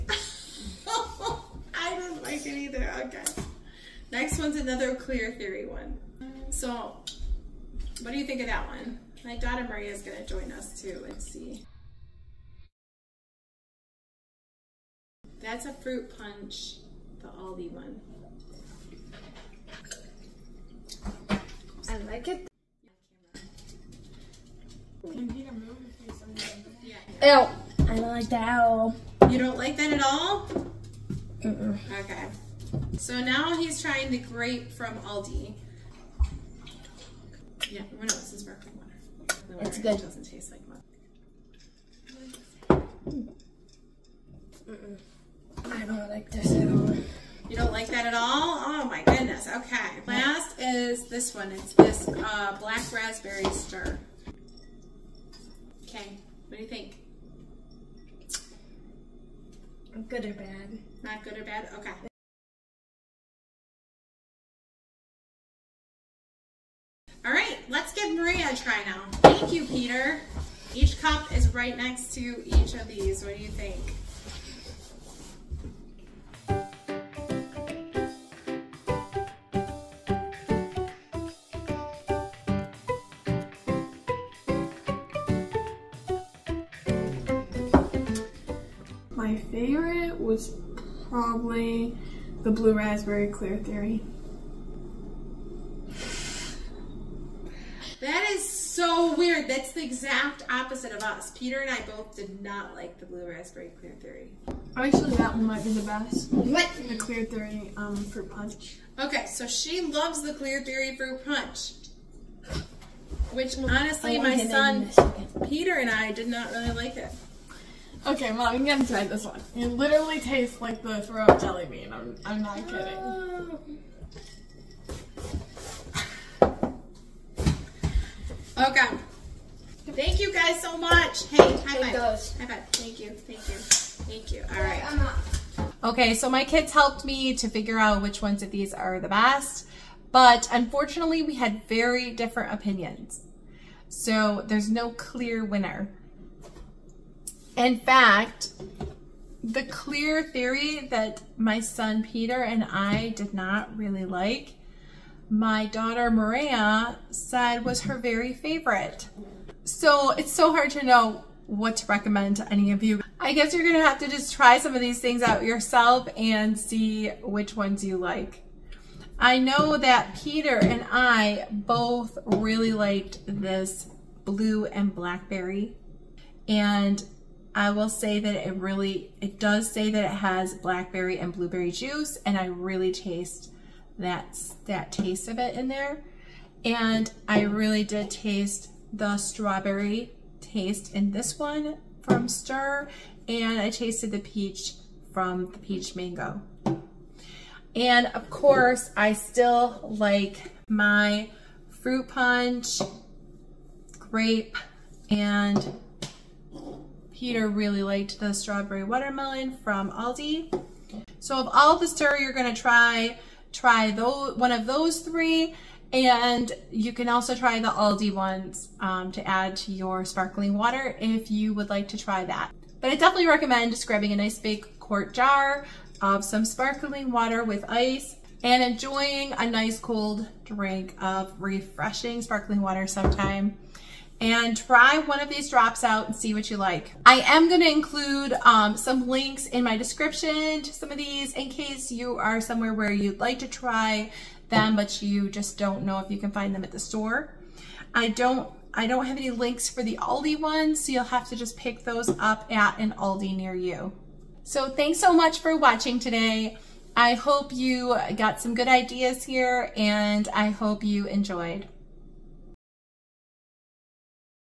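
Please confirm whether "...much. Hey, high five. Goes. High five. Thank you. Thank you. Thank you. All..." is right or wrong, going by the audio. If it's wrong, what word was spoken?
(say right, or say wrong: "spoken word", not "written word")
right.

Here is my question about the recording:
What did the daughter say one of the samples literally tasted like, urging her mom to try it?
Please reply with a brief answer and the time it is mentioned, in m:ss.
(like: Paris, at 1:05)
The throw-up jelly bean, at 2:00.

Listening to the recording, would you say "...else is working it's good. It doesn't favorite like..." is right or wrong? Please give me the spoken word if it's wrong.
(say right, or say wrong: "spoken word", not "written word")
wrong: "taste", not "favorite".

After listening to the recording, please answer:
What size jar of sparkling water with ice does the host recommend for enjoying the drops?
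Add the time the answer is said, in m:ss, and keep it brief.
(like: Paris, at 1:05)
Quart, at 3:44.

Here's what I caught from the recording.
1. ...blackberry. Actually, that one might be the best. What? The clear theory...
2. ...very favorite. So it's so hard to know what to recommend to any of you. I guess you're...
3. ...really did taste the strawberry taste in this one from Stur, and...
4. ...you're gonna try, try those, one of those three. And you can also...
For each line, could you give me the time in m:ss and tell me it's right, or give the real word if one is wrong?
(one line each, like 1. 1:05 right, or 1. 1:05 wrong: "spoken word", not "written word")
1. 1:44 wrong: "theory", not "blackberry"
2. 2:37 right
3. 3:07 right
4. 3:32 right.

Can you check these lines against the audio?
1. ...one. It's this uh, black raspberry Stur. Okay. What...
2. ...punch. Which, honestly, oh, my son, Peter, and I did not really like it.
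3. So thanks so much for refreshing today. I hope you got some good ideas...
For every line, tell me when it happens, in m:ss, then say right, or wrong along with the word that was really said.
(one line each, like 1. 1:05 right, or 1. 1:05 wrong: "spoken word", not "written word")
1. 0:51 right
2. 1:51 right
3. 4:14 wrong: "watching", not "refreshing".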